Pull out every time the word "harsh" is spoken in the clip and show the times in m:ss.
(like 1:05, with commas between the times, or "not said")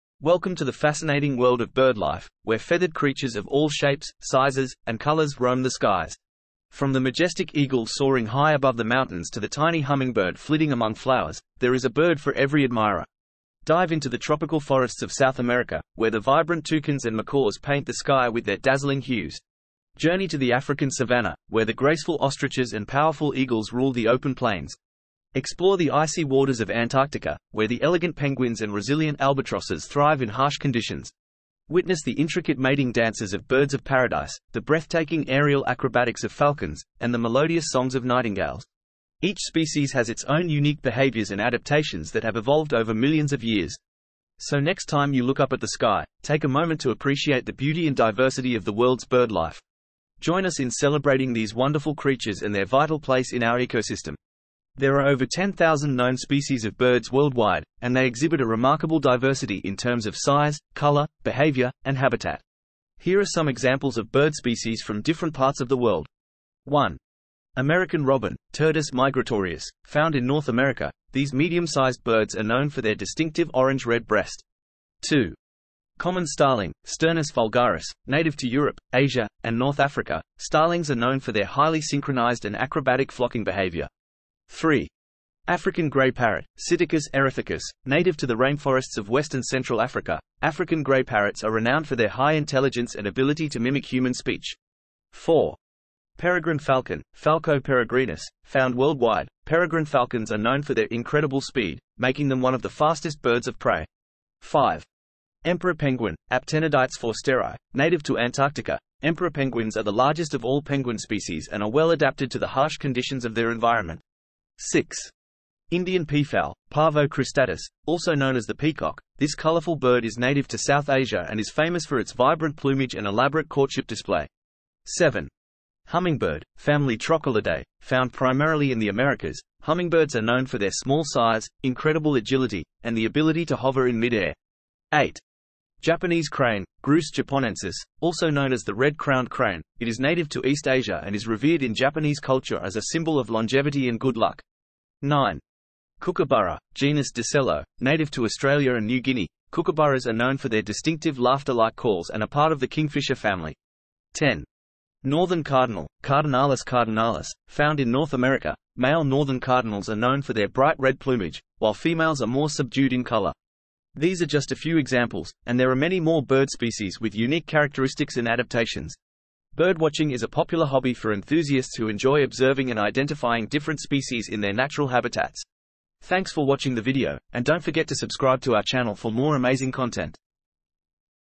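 0:30, 1:52.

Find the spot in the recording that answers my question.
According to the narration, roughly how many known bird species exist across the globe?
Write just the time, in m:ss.
0:55.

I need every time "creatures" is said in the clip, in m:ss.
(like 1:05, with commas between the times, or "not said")
0:02, 0:51.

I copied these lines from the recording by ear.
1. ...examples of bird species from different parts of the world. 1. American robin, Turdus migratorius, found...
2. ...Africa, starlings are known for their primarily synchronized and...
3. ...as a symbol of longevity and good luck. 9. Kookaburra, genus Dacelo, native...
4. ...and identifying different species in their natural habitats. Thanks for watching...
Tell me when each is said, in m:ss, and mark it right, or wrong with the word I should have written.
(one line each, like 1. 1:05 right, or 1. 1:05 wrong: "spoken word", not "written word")
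1. 1:03 right
2. 1:19 wrong: "highly", not "primarily"
3. 2:22 right
4. 2:52 right.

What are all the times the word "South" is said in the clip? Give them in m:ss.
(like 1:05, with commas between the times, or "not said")
0:15, 2:00.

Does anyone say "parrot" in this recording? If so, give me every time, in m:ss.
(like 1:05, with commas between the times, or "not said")
1:26, 1:31.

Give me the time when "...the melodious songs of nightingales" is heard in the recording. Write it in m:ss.
0:37.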